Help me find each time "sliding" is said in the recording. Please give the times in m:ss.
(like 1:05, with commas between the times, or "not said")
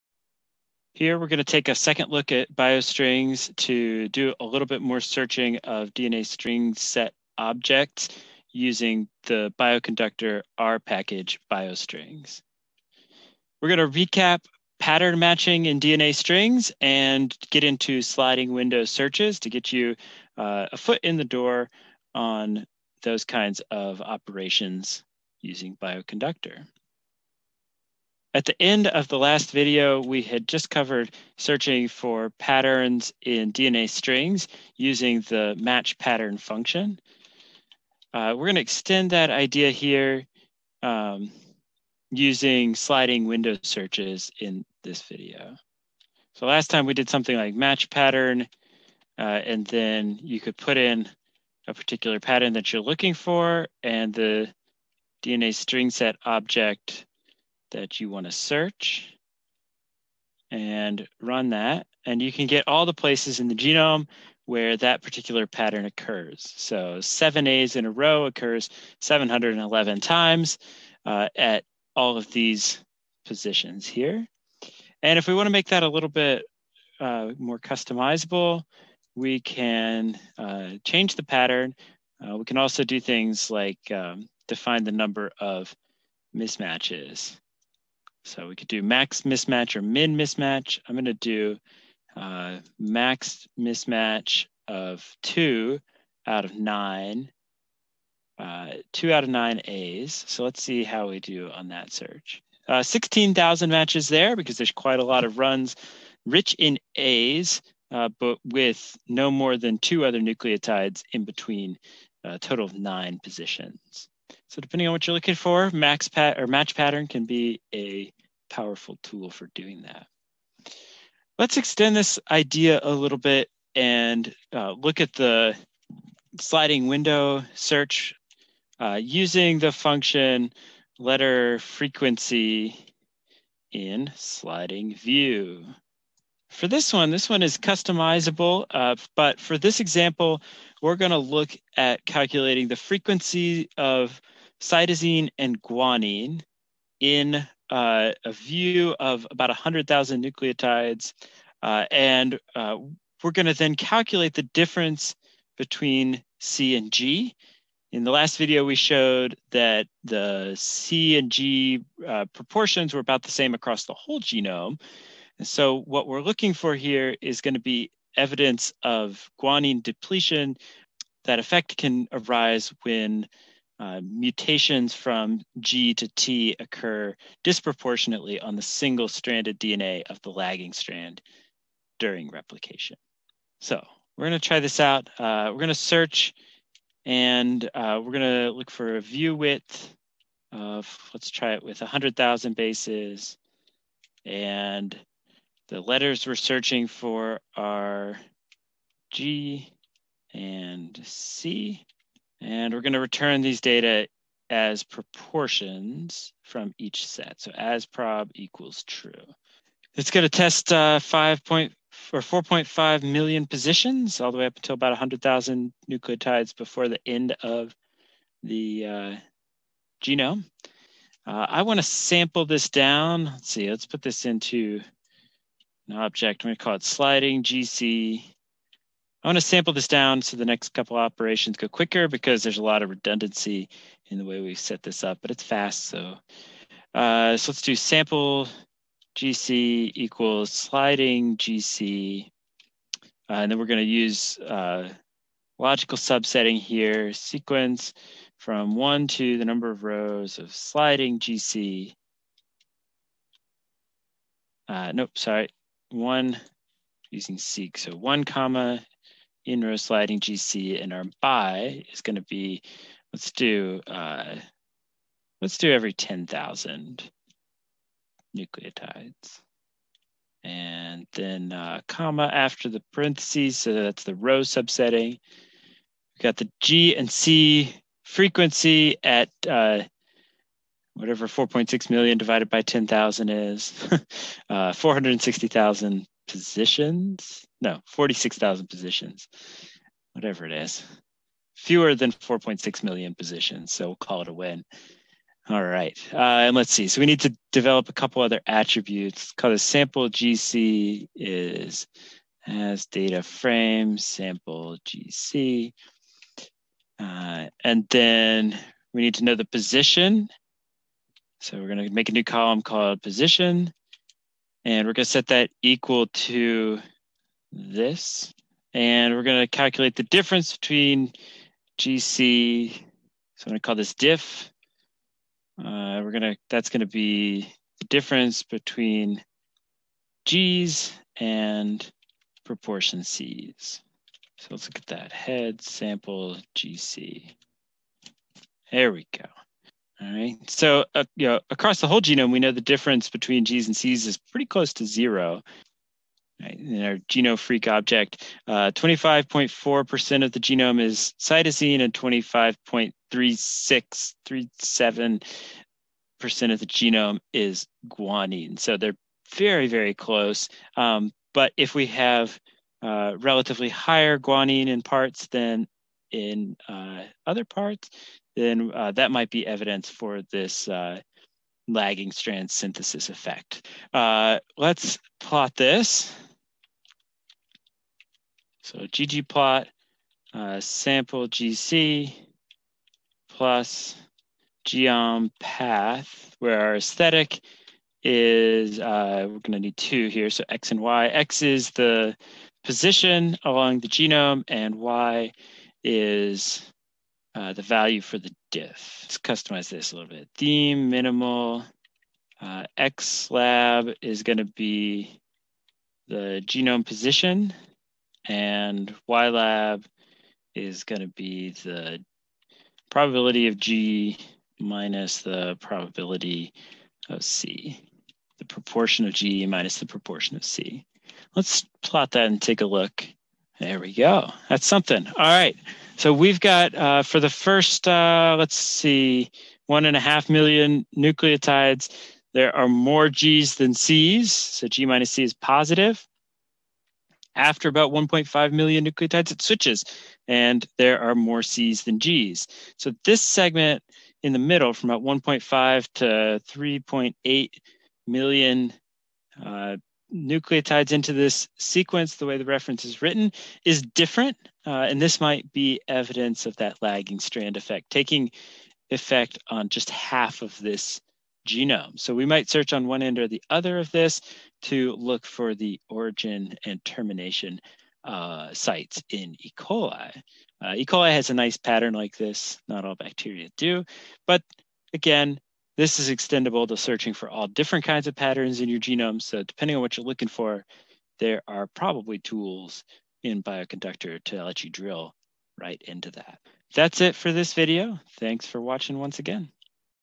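0:18, 0:42, 2:06, 2:14, 3:46, 4:00, 4:10, 4:19.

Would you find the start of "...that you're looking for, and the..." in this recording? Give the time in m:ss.
0:52.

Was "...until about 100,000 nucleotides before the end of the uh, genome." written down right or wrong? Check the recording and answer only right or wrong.
right.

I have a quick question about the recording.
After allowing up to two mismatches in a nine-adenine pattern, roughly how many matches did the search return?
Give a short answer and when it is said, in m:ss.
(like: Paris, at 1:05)
16,000, at 1:42.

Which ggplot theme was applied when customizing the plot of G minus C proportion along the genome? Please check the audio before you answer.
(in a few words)
theme minimal.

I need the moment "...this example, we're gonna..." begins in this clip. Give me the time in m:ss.
2:19.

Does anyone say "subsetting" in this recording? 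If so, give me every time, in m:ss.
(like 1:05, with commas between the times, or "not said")
4:05, 4:34.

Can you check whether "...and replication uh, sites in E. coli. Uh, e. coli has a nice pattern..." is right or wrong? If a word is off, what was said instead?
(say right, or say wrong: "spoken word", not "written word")
wrong: "termination", not "replication".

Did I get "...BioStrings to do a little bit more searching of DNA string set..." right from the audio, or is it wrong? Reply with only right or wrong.
right.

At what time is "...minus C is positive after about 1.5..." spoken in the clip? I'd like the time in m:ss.
7:14.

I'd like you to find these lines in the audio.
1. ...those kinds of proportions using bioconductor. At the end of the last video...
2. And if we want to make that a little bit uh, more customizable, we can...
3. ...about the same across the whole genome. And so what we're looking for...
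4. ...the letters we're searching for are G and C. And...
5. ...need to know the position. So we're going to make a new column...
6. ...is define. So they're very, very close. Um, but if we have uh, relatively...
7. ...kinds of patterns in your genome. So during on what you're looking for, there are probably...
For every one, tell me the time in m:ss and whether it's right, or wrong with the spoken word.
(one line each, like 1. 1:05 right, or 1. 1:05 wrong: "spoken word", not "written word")
1. 0:23 wrong: "operations", not "proportions"
2. 1:15 right
3. 2:43 right
4. 3:15 right
5. 5:09 right
6. 5:57 wrong: "guanine", not "define"
7. 7:57 wrong: "depending", not "during".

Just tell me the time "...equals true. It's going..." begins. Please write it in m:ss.
3:28.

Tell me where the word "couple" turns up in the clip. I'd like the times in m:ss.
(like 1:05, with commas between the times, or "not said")
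3:50, 4:57.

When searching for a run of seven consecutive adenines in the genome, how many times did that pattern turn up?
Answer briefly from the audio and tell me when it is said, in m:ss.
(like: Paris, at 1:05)
711, at 1:08.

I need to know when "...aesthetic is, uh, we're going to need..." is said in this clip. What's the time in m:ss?
6:26.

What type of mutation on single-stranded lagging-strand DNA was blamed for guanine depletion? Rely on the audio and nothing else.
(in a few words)
G to T.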